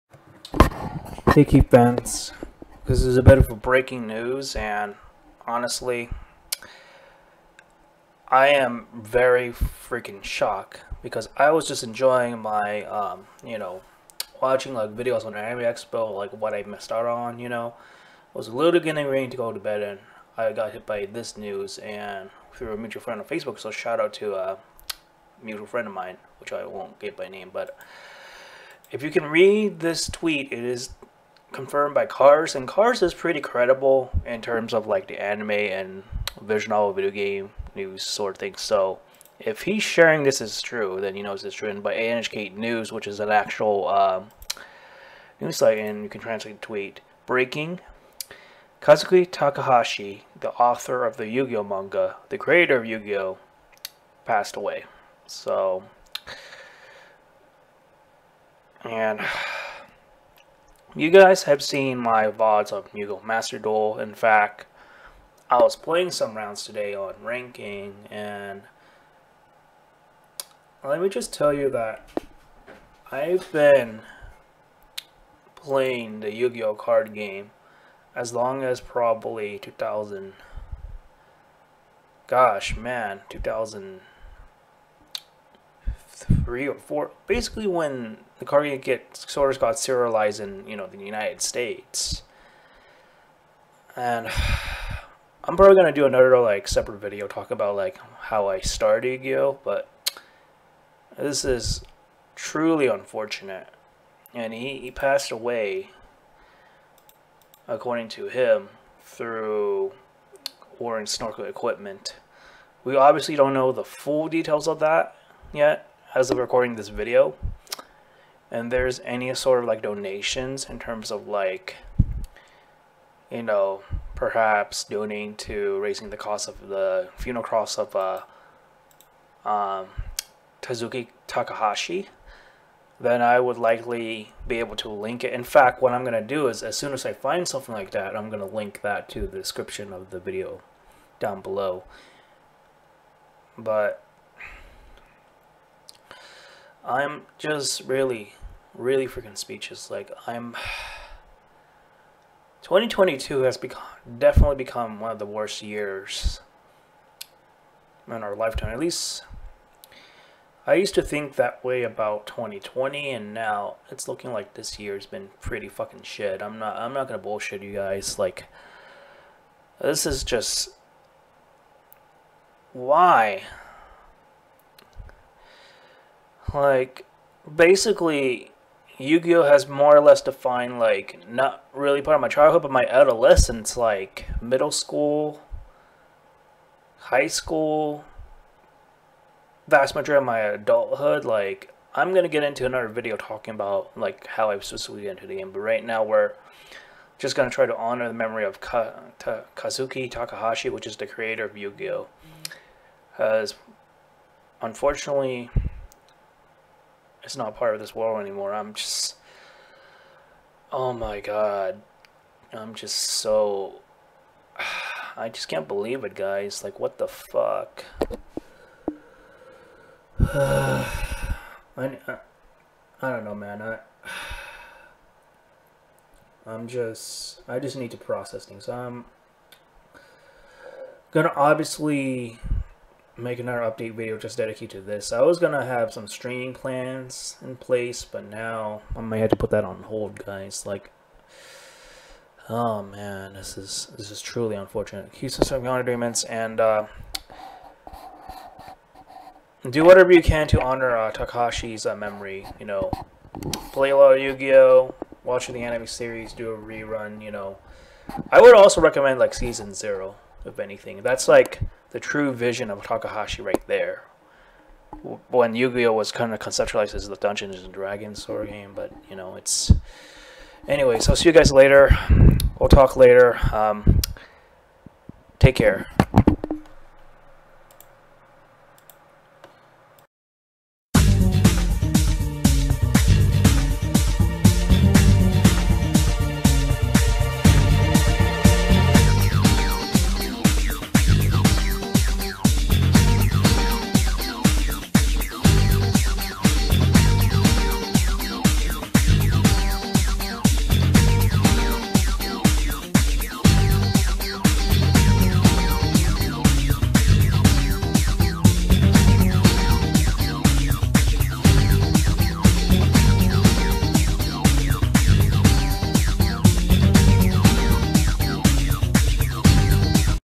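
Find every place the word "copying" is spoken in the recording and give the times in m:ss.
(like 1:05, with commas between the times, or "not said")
not said.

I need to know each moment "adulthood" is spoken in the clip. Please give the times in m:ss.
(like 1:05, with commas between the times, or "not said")
3:10.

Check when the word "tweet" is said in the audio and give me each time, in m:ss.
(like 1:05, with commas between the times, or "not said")
0:30, 0:46.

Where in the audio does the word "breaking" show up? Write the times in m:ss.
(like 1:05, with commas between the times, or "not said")
0:03, 0:47.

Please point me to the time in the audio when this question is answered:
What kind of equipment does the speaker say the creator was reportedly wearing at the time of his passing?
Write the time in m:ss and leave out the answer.
1:51.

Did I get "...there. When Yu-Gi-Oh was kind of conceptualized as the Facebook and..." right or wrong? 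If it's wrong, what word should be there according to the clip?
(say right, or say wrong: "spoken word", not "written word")
wrong: "Dungeons", not "Facebook".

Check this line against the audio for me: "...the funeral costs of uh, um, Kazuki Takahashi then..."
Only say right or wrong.
right.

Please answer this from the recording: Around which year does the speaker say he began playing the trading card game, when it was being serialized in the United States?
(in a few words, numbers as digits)
2003.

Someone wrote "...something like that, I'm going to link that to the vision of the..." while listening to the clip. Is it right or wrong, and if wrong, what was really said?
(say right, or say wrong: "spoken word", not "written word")
wrong: "description", not "vision".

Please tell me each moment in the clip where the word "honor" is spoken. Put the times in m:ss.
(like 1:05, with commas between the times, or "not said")
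3:17, 4:05, 4:10.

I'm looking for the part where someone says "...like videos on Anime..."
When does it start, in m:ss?
0:14.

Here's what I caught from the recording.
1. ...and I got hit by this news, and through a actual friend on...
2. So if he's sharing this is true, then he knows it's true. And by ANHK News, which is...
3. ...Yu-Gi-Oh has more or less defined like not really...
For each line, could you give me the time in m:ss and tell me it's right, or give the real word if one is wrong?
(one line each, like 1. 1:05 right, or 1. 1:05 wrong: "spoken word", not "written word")
1. 0:19 wrong: "mutual", not "actual"
2. 0:38 right
3. 2:58 right.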